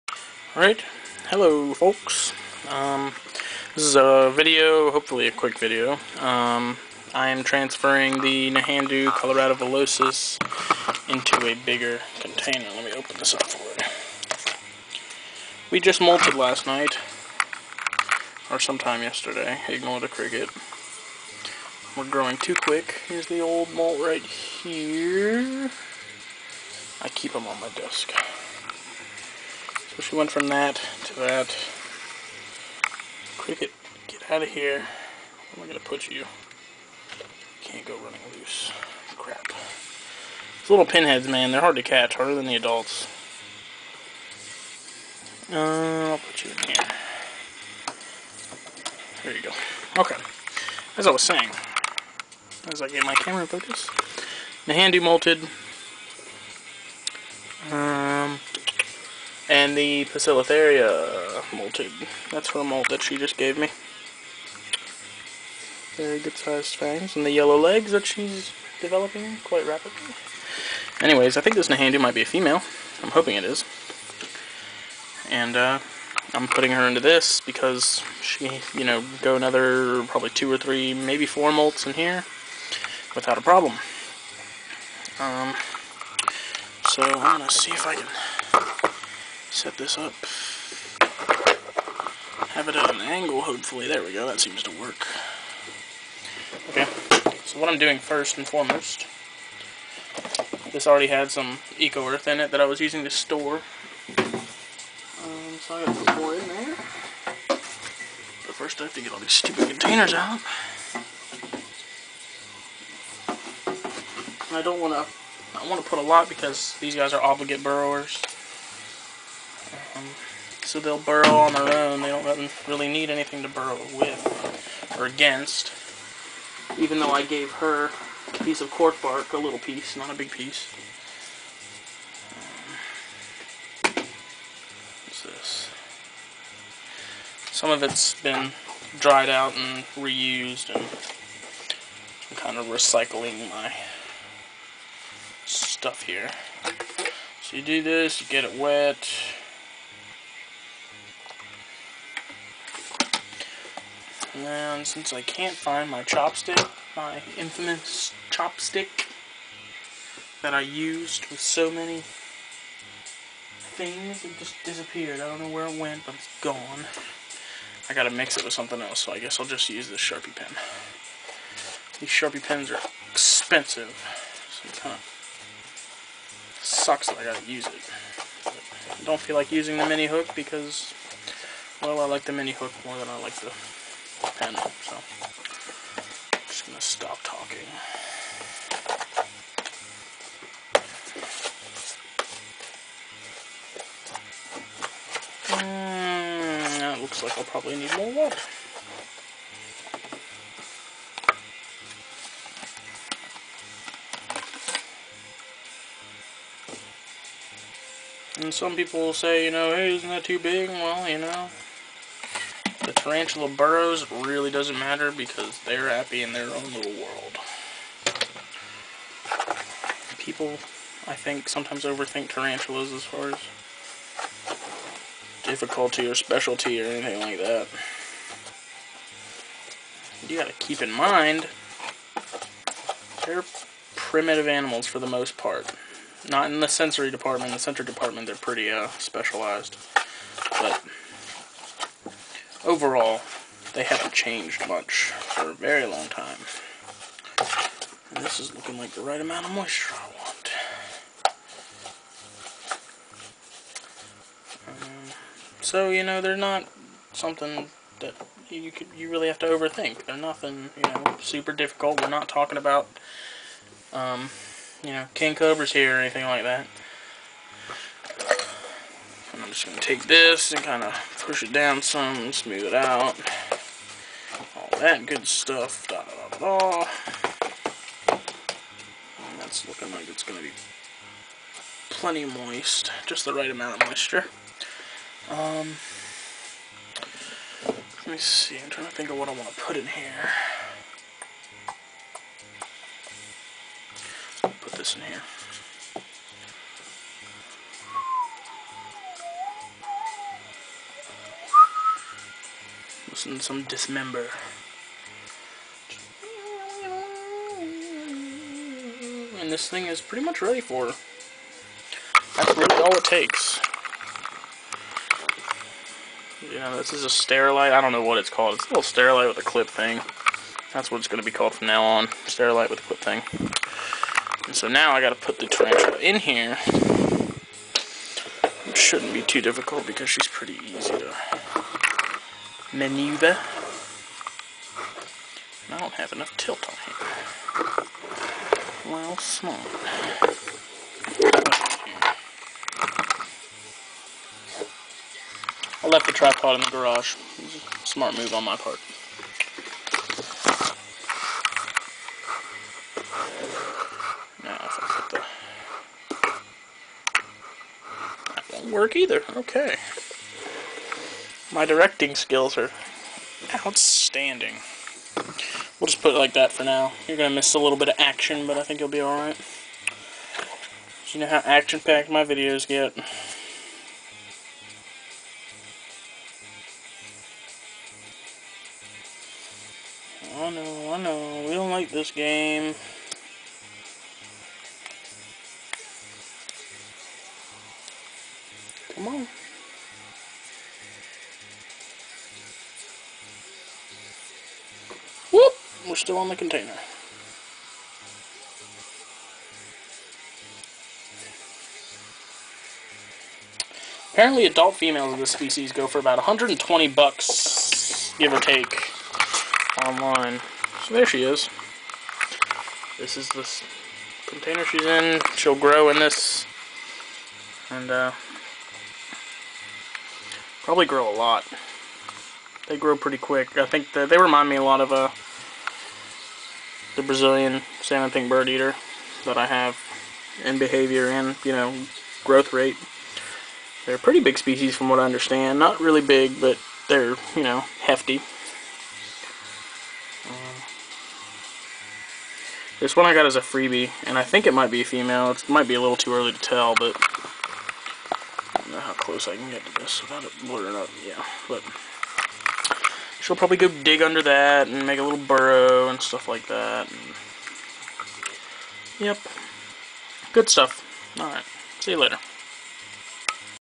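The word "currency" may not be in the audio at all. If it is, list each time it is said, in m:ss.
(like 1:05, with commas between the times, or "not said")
not said.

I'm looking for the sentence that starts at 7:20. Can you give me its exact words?
Um, this one I got as a freebie, and I think it might be a female.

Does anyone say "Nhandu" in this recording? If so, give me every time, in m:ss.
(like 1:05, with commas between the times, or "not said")
0:08, 1:11.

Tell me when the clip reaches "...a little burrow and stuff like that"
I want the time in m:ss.
7:34.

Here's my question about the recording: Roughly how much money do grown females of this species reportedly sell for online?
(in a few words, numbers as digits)
$120.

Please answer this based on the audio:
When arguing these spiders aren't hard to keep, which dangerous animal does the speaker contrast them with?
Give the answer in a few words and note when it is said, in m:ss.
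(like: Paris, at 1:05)
king cobras, at 4:25.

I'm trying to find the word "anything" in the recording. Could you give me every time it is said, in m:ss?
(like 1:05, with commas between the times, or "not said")
2:03, 3:46, 4:25.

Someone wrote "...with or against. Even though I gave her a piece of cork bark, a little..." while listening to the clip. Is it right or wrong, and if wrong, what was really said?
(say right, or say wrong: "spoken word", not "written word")
right.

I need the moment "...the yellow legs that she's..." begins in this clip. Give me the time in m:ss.
1:07.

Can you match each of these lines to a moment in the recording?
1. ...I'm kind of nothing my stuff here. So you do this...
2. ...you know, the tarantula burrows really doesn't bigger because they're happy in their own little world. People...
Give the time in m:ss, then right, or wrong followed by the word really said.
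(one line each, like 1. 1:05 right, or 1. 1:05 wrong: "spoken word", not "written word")
1. 2:22 wrong: "recycling", not "nothing"
2. 3:31 wrong: "matter", not "bigger".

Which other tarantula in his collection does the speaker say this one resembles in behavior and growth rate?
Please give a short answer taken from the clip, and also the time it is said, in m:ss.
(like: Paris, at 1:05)
Brazilian salmon pink bird eater, at 7:07.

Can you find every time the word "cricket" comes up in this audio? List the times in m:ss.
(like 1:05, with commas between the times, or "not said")
0:20, 0:33.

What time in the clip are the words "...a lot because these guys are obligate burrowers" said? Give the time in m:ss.
1:55.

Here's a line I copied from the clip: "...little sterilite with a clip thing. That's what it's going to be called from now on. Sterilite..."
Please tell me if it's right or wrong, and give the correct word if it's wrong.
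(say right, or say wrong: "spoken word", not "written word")
right.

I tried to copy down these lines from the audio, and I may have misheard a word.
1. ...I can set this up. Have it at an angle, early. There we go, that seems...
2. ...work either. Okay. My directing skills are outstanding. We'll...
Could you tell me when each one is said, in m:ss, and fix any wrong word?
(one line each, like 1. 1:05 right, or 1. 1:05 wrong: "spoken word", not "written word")
1. 1:27 wrong: "hopefully", not "early"
2. 5:58 right.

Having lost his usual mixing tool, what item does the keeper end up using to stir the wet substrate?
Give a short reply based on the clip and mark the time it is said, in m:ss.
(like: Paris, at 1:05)
Sharpie pen, at 2:50.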